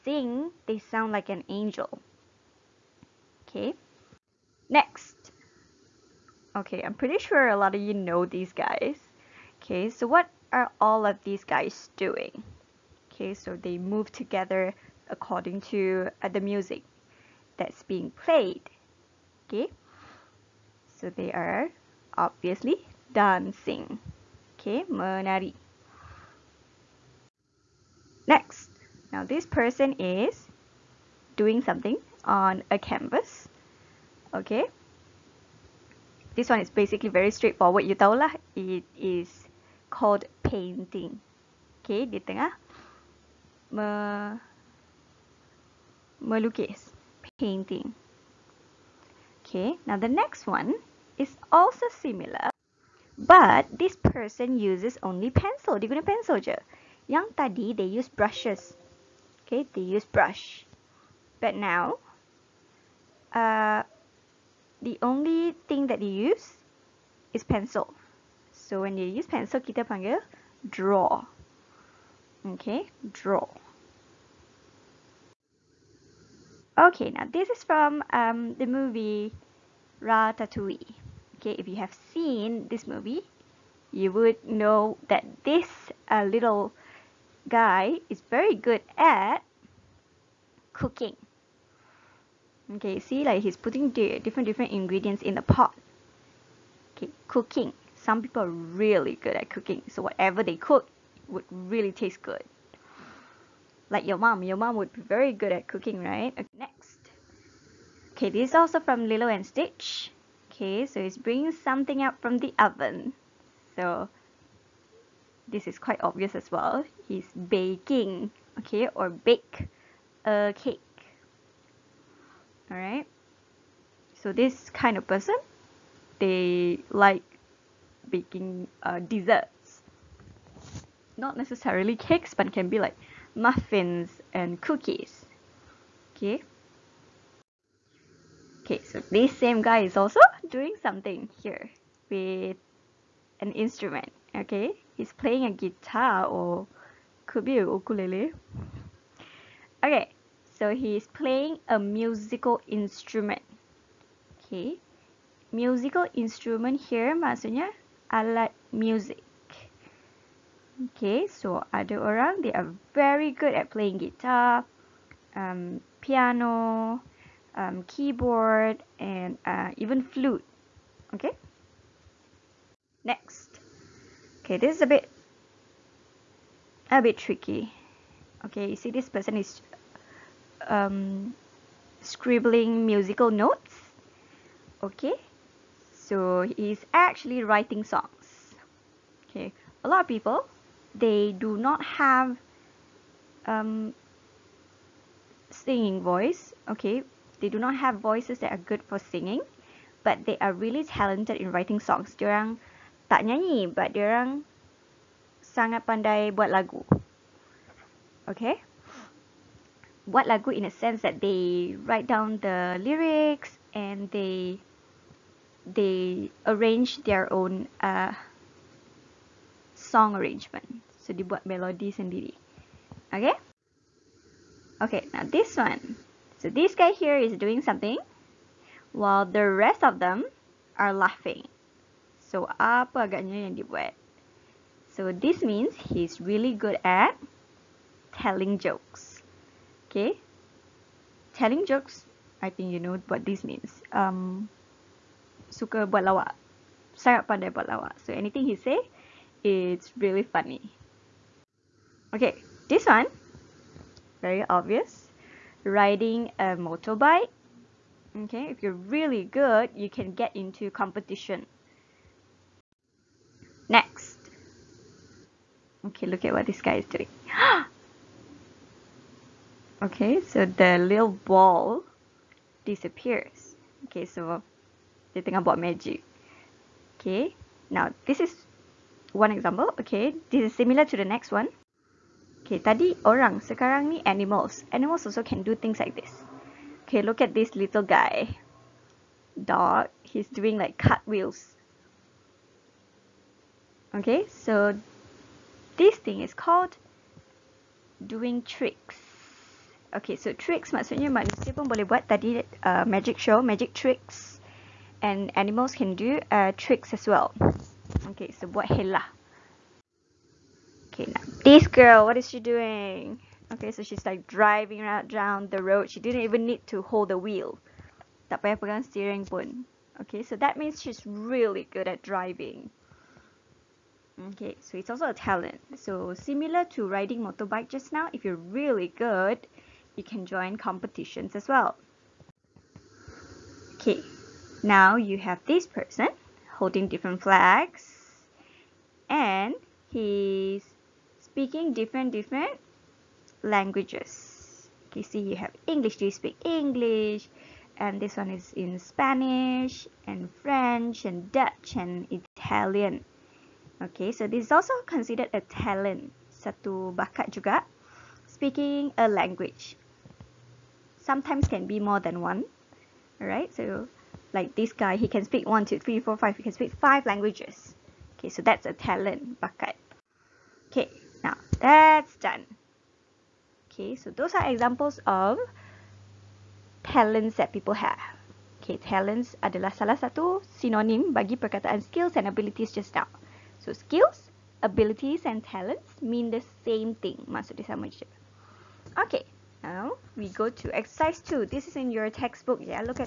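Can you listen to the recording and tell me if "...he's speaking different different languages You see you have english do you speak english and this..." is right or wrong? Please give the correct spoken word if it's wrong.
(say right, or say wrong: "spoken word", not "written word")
right.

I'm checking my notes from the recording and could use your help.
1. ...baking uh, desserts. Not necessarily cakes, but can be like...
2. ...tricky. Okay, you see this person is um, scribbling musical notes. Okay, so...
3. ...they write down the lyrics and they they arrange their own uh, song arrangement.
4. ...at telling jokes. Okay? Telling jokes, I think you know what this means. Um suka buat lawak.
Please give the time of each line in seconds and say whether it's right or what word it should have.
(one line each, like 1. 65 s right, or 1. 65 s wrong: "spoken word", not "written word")
1. 128 s right
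2. 177 s right
3. 211 s right
4. 236 s right.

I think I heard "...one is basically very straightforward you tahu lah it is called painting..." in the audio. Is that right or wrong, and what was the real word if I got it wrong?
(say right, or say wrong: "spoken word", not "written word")
right.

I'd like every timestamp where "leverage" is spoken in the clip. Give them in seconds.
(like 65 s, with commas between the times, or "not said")
not said.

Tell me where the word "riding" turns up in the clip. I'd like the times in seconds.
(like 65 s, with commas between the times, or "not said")
255 s, 326 s.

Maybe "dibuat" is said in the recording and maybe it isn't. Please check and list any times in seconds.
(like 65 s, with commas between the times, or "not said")
221 s, 233 s.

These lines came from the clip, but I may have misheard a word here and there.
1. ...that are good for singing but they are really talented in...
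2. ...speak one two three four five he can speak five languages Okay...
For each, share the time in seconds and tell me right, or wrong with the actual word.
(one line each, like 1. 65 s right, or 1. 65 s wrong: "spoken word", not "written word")
1. 198 s right
2. 365 s right.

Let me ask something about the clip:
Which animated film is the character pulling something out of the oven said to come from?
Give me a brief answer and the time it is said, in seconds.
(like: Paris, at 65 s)
Lilo and Stitch, at 109 s.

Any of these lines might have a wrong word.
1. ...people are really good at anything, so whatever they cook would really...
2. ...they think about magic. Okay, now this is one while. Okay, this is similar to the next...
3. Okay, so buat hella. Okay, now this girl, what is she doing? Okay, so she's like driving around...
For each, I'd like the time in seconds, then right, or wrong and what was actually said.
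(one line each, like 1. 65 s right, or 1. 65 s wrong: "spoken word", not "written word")
1. 98 s wrong: "cooking", not "anything"
2. 275 s wrong: "example", not "while"
3. 308 s right.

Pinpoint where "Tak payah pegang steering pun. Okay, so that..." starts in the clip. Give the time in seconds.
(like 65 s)
318 s.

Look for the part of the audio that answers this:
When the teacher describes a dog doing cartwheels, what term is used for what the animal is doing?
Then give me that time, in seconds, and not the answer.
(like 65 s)
298 s.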